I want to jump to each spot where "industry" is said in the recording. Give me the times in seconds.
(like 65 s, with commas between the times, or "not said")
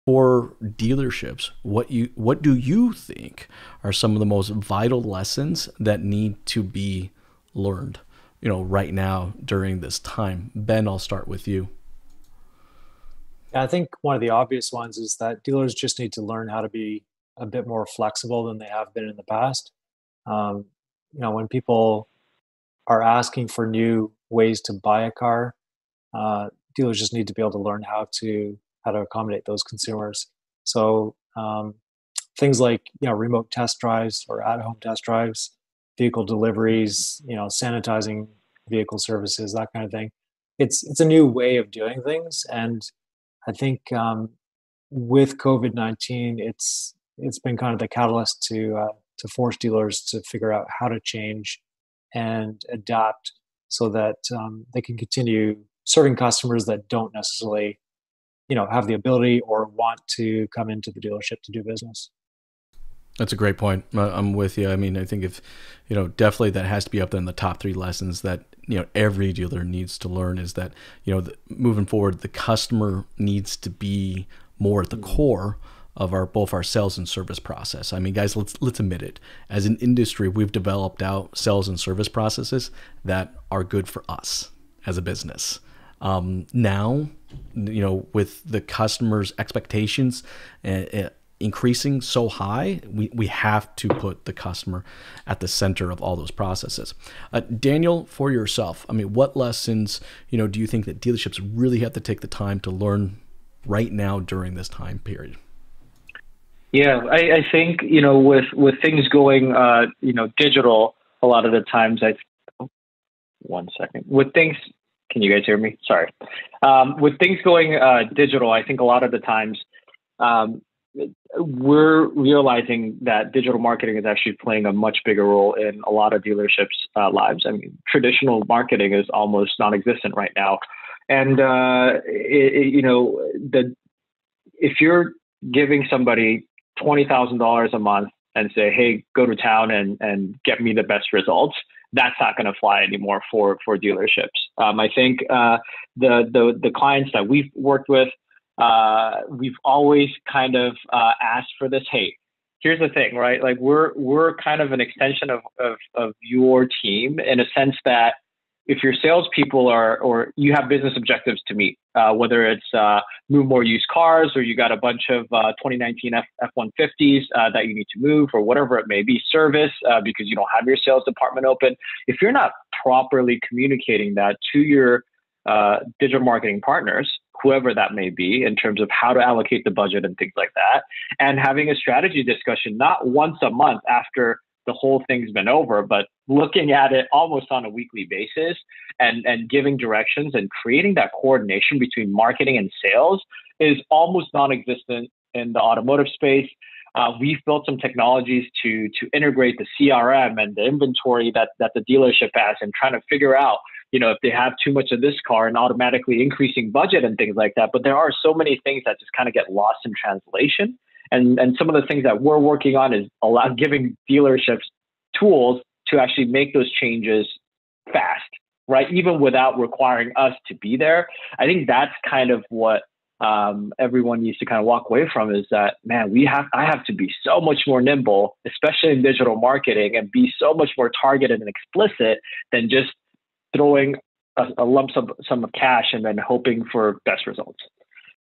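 79 s.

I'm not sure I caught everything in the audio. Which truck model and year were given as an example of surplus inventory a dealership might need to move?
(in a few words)
2019 F-150s.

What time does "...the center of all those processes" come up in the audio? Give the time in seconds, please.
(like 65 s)
95 s.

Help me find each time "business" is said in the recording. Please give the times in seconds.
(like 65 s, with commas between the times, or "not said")
61 s, 85 s, 160 s.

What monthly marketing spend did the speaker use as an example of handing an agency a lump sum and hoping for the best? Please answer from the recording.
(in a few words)
$20,000.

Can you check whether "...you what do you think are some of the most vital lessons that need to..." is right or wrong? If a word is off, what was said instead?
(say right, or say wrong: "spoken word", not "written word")
right.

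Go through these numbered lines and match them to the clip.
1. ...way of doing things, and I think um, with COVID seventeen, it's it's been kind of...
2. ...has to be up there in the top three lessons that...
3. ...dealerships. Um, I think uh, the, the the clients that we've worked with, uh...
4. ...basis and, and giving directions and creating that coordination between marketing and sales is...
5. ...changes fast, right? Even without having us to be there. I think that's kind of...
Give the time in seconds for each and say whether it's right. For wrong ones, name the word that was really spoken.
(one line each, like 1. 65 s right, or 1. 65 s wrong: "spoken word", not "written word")
1. 41 s wrong: "nineteen", not "seventeen"
2. 66 s right
3. 143 s right
4. 188 s right
5. 216 s wrong: "requiring", not "having".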